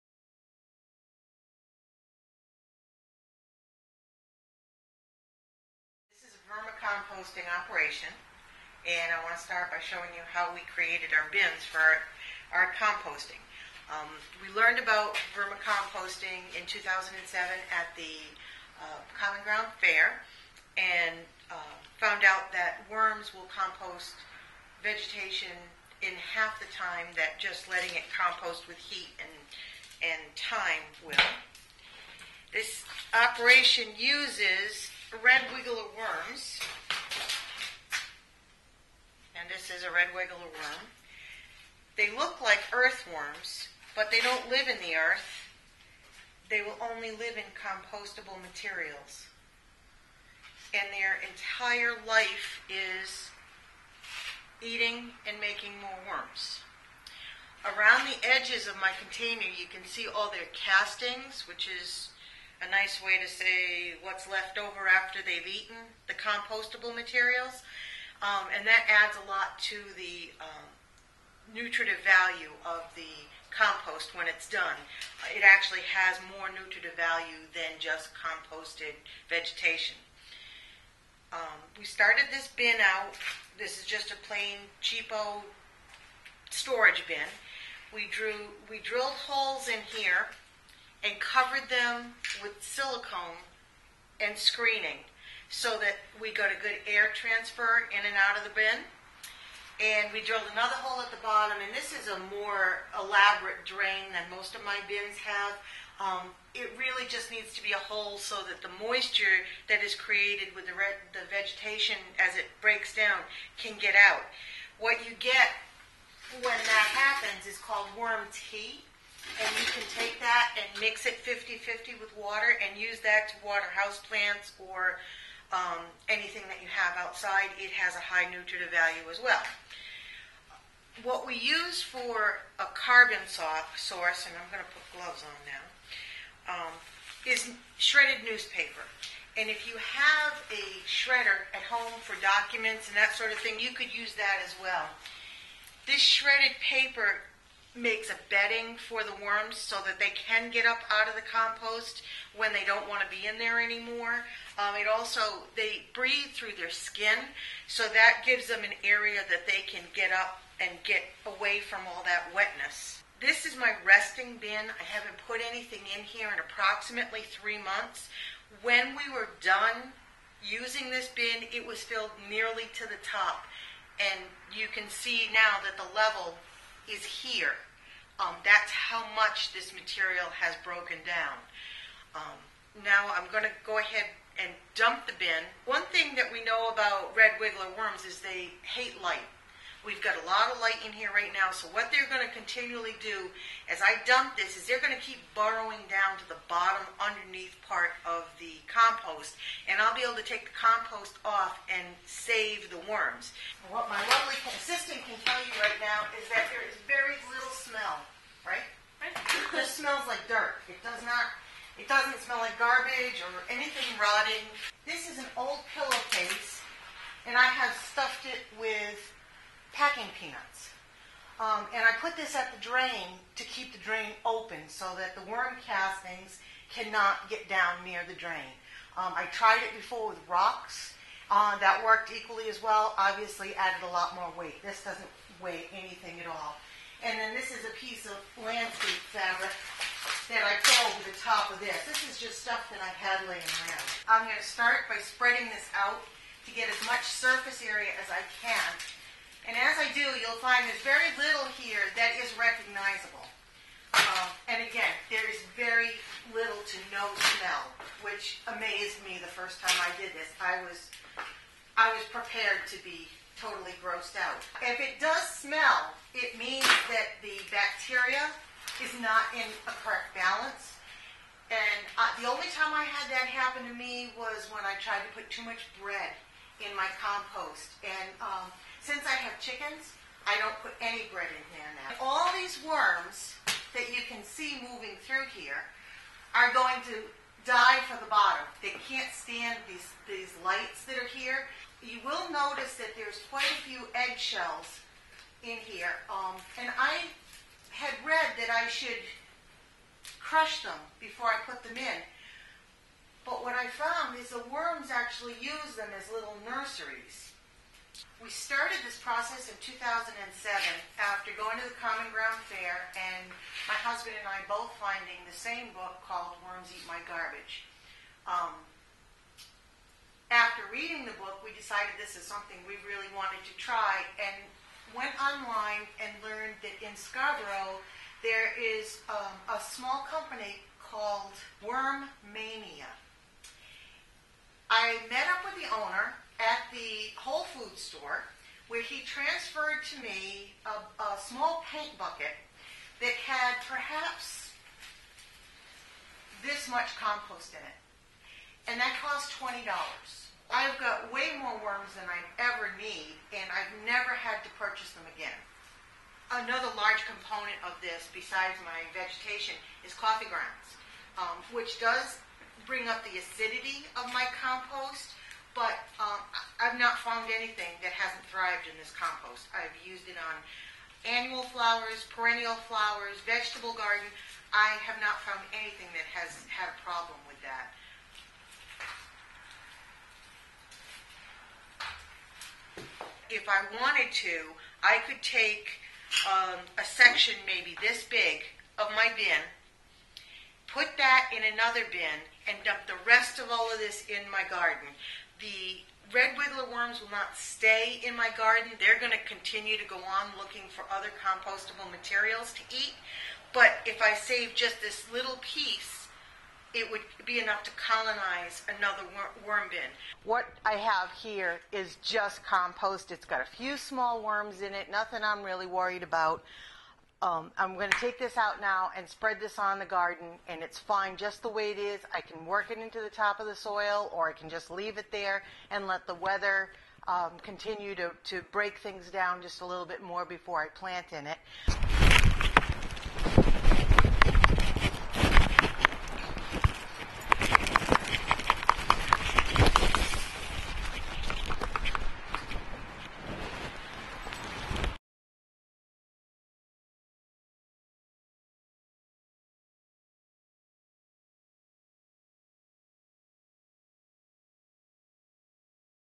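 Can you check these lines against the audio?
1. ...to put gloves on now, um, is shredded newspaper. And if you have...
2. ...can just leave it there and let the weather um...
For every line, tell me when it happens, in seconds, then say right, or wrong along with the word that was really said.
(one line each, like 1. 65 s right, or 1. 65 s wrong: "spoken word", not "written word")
1. 134 s right
2. 424 s right.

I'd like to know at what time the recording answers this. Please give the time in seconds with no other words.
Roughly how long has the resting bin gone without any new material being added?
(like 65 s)
167 s.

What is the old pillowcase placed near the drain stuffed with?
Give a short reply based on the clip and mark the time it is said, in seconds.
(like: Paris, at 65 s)
packing peanuts, at 219 s.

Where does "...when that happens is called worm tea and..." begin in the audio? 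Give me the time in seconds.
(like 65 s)
116 s.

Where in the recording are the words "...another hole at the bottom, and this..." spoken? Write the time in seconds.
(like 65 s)
100 s.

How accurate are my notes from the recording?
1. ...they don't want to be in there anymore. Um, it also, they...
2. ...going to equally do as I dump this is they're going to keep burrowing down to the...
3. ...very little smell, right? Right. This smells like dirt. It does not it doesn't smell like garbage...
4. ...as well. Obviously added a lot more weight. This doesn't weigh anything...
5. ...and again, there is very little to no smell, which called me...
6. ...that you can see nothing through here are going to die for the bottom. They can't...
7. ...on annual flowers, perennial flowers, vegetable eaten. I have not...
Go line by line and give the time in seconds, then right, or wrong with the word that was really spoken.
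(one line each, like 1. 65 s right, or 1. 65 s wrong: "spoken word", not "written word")
1. 152 s right
2. 192 s wrong: "continually", not "equally"
3. 206 s right
4. 232 s right
5. 254 s wrong: "amazed", not "called"
6. 283 s wrong: "moving", not "nothing"
7. 370 s wrong: "garden", not "eaten".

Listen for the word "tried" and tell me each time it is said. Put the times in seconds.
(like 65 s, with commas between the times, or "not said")
229 s, 274 s.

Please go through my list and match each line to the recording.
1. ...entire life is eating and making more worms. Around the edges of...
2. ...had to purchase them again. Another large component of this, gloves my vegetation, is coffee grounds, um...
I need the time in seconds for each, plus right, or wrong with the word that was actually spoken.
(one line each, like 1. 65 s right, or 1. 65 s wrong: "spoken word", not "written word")
1. 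51 s right
2. 354 s wrong: "besides", not "gloves".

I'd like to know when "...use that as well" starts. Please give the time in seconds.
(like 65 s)
143 s.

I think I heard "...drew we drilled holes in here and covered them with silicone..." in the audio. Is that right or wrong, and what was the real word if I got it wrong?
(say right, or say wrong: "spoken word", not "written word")
right.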